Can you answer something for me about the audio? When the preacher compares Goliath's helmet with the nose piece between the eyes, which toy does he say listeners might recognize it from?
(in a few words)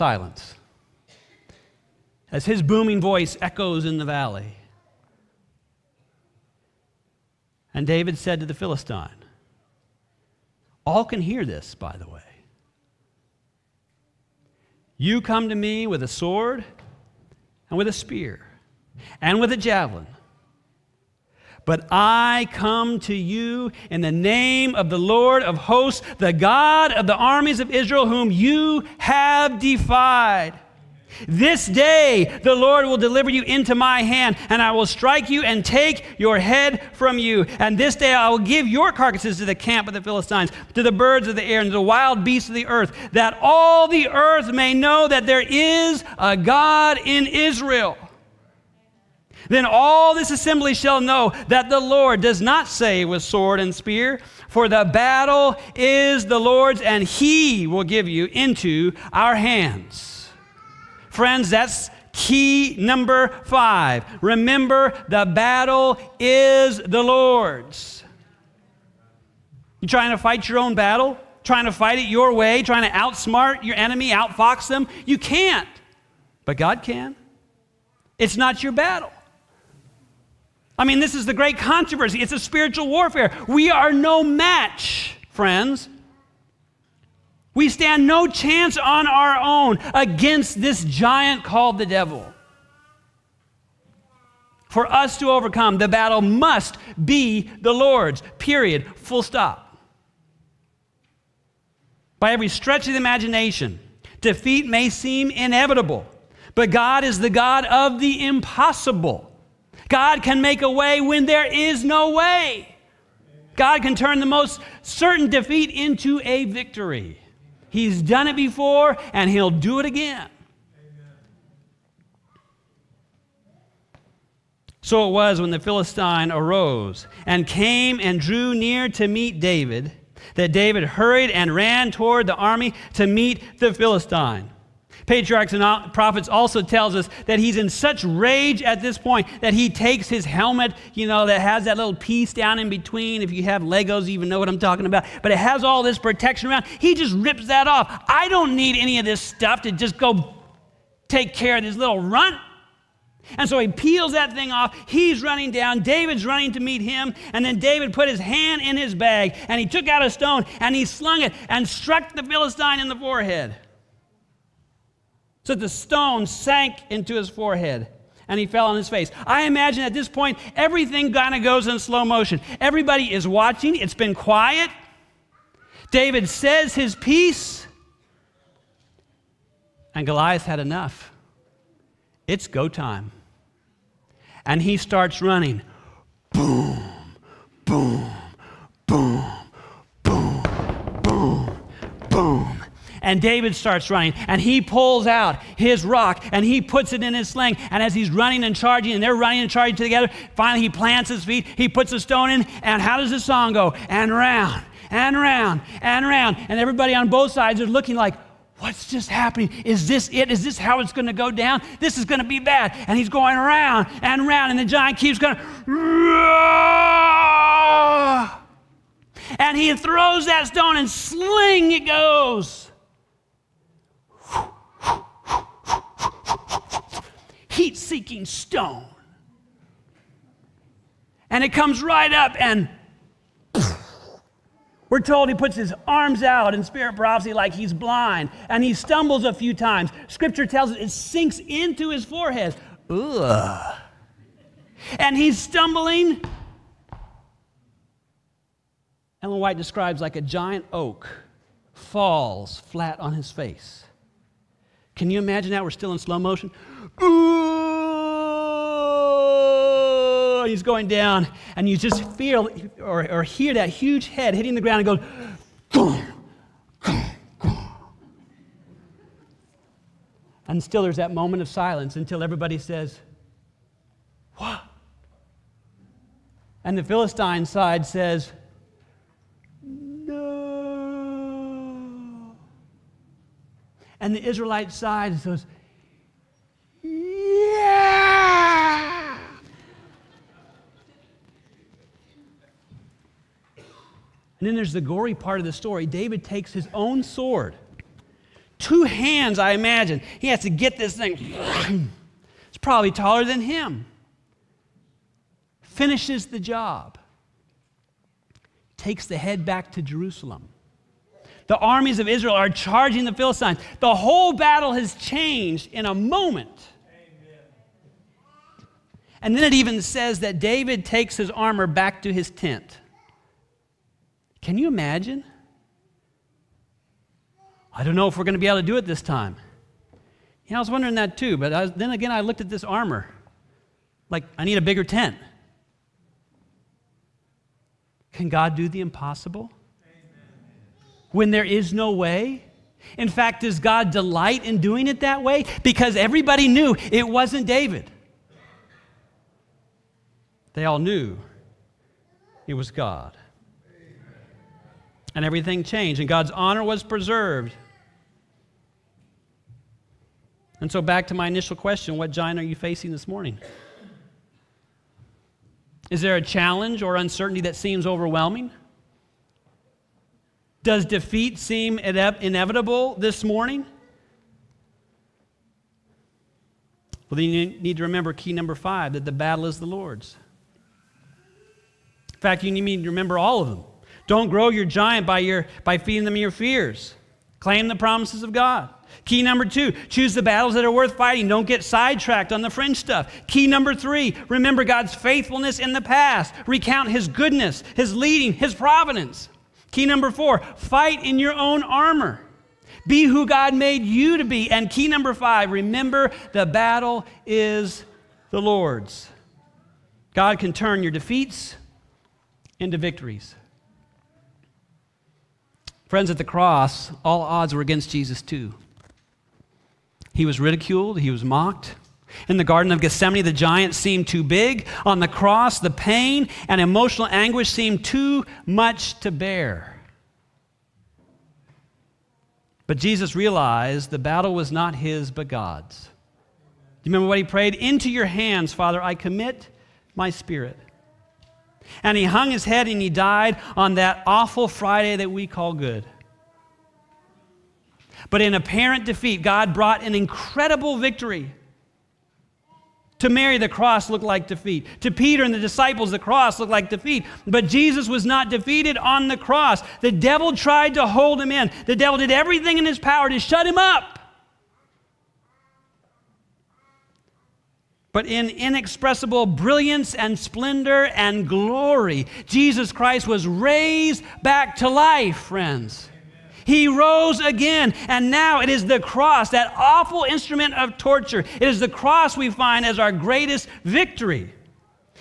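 Legos.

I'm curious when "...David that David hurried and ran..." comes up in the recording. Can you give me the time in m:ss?
2:09.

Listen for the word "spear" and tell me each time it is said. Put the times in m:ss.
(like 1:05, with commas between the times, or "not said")
0:17, 0:53.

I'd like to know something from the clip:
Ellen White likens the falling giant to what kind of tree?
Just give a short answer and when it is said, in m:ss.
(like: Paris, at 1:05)
A giant oak, at 4:10.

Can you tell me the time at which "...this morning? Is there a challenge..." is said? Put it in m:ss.
6:02.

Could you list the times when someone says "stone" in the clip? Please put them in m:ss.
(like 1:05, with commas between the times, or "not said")
2:40, 2:45, 3:22, 3:40, 3:48.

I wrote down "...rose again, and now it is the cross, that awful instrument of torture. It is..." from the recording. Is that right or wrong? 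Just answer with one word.
right.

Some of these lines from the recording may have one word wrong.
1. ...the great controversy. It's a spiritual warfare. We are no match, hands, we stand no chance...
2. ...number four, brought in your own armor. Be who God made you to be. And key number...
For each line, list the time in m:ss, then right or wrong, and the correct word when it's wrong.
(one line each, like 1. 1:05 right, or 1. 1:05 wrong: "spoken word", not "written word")
1. 1:21 wrong: "friends", not "hands"
2. 6:39 wrong: "fight", not "brought".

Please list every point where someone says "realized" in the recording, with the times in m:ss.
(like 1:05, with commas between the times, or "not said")
7:13.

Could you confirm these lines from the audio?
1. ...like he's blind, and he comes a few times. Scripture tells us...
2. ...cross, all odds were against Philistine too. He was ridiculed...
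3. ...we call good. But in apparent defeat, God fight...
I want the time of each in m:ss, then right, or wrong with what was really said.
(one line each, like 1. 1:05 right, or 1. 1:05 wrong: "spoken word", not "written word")
1. 3:57 wrong: "stumbles", not "comes"
2. 6:56 wrong: "Jesus", not "Philistine"
3. 7:25 wrong: "brought", not "fight".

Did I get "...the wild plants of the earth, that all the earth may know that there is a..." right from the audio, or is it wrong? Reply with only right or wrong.
wrong.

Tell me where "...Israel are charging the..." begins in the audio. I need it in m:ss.
5:12.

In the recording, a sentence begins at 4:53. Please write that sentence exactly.
And then there's the gory part of the story.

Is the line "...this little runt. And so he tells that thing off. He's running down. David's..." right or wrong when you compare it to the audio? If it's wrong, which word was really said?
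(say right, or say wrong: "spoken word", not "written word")
wrong: "peels", not "tells".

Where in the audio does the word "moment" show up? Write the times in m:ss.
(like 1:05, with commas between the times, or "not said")
4:31, 5:15.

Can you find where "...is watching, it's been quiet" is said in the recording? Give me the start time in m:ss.
2:53.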